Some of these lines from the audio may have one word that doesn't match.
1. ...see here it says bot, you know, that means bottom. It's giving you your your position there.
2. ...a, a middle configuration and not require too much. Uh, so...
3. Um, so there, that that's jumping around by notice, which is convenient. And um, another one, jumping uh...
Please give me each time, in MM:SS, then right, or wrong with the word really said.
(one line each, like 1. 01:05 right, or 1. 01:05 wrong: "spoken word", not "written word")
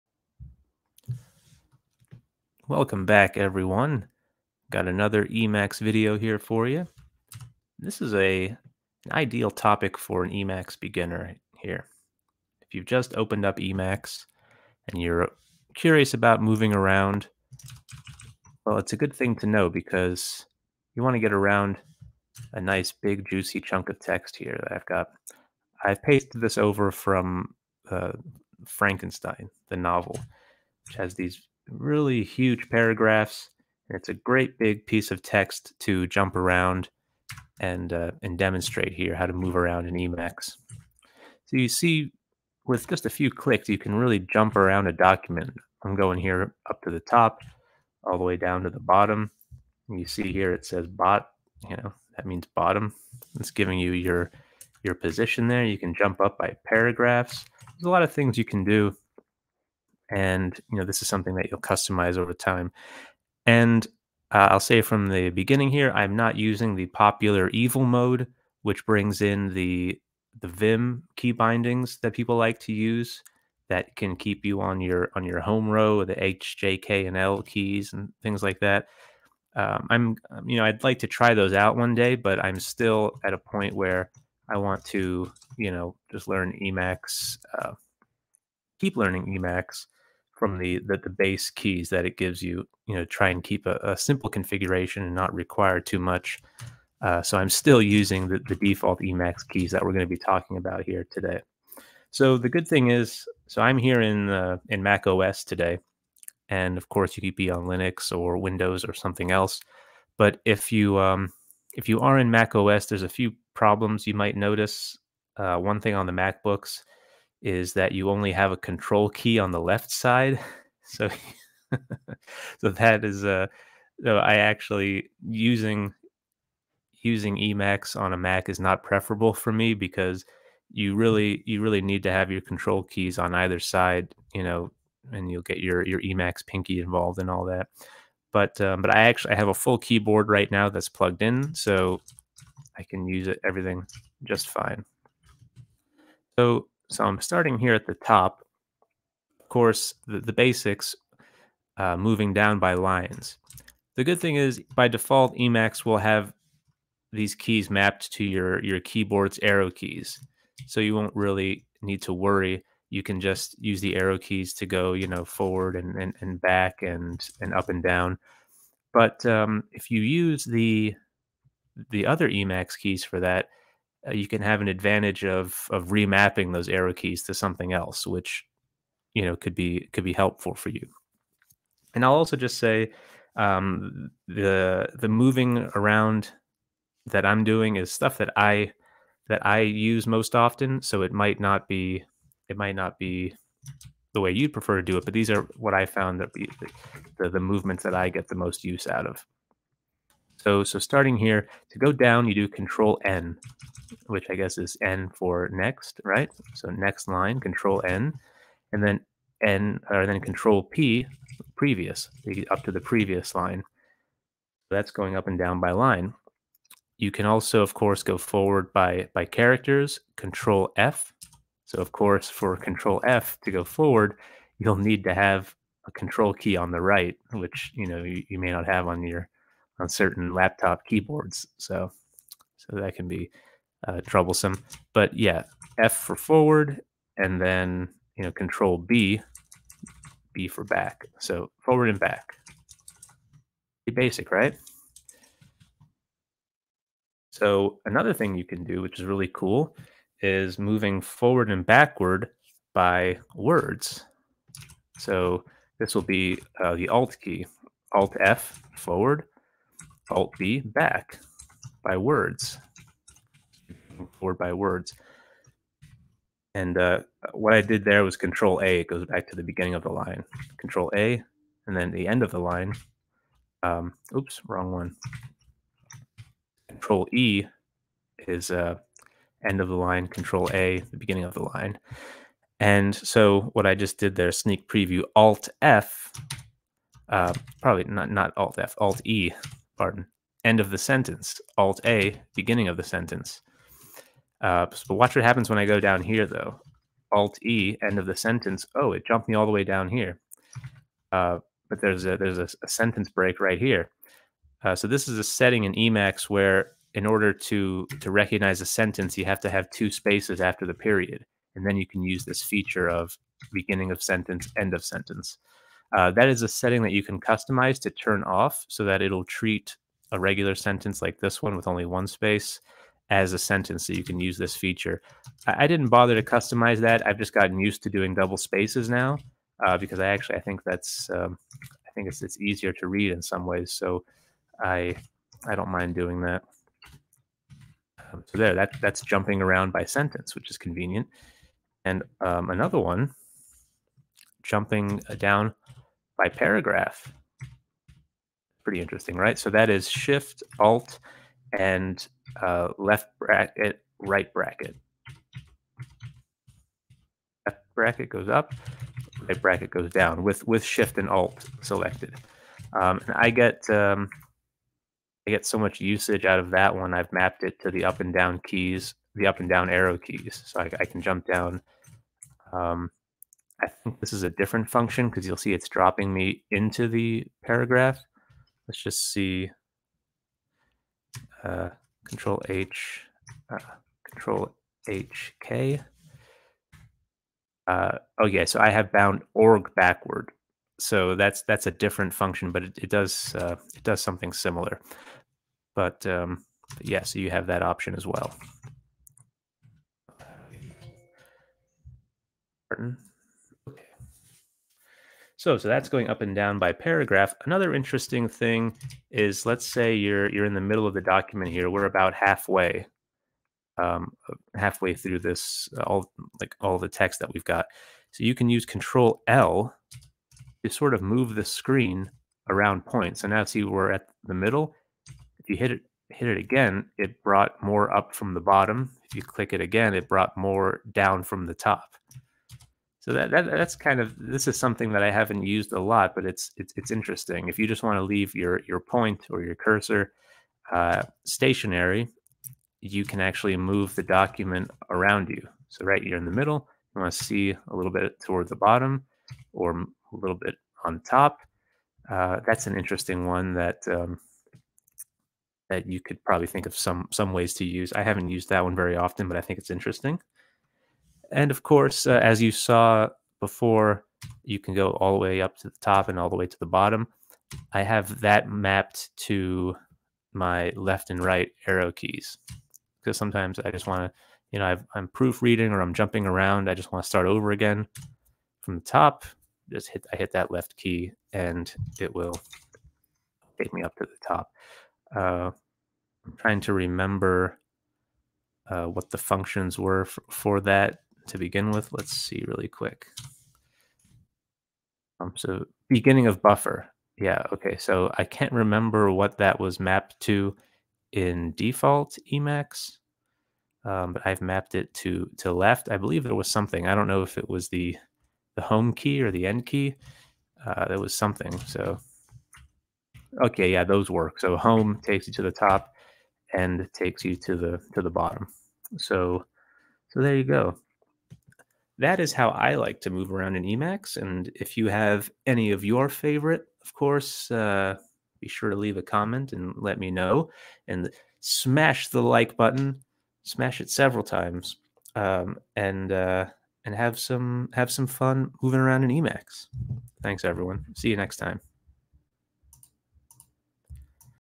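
1. 00:50 right
2. 01:33 wrong: "simple", not "middle"
3. 05:38 wrong: "sentence", not "notice".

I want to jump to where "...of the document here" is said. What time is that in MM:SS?
06:50.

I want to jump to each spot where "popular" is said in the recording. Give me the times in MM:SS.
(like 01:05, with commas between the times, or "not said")
01:06.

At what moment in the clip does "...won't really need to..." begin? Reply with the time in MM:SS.
02:40.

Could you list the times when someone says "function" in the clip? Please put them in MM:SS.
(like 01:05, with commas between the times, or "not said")
06:14, 06:32, 08:09.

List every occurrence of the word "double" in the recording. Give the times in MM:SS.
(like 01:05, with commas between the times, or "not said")
05:28.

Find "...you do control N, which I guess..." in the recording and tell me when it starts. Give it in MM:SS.
03:22.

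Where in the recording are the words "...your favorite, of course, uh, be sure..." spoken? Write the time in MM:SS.
08:45.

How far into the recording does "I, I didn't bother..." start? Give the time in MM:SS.
05:25.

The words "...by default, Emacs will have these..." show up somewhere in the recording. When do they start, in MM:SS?
02:34.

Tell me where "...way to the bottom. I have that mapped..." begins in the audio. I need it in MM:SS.
07:46.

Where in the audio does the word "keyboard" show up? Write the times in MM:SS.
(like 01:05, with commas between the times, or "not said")
02:19, 02:38, 03:50.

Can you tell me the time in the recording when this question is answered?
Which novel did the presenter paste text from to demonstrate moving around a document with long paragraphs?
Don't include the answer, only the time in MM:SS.
00:28.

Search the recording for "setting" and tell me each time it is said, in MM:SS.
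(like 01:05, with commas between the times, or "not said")
05:05, 05:16.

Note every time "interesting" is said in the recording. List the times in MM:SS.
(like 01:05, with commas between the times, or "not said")
05:48, 06:47, 07:16, 07:32, 07:39.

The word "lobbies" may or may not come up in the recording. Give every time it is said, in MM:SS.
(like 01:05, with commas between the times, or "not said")
not said.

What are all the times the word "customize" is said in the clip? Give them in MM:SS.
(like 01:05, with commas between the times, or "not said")
01:01, 05:17, 05:26.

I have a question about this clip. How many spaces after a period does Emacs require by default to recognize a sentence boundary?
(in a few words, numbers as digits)
2.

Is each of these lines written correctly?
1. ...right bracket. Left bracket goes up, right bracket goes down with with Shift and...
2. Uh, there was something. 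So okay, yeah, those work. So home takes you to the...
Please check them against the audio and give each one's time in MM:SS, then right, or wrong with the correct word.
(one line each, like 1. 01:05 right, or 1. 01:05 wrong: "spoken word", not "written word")
1. 05:53 right
2. 08:30 right.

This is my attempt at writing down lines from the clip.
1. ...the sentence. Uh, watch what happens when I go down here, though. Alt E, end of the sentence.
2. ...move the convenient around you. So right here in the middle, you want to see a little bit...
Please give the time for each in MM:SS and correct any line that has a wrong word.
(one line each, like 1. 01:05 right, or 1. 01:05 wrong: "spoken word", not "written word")
1. 04:52 right
2. 07:23 wrong: "document", not "convenient".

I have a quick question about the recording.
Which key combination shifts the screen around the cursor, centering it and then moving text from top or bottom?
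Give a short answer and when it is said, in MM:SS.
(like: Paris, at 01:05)
Control L, at 06:58.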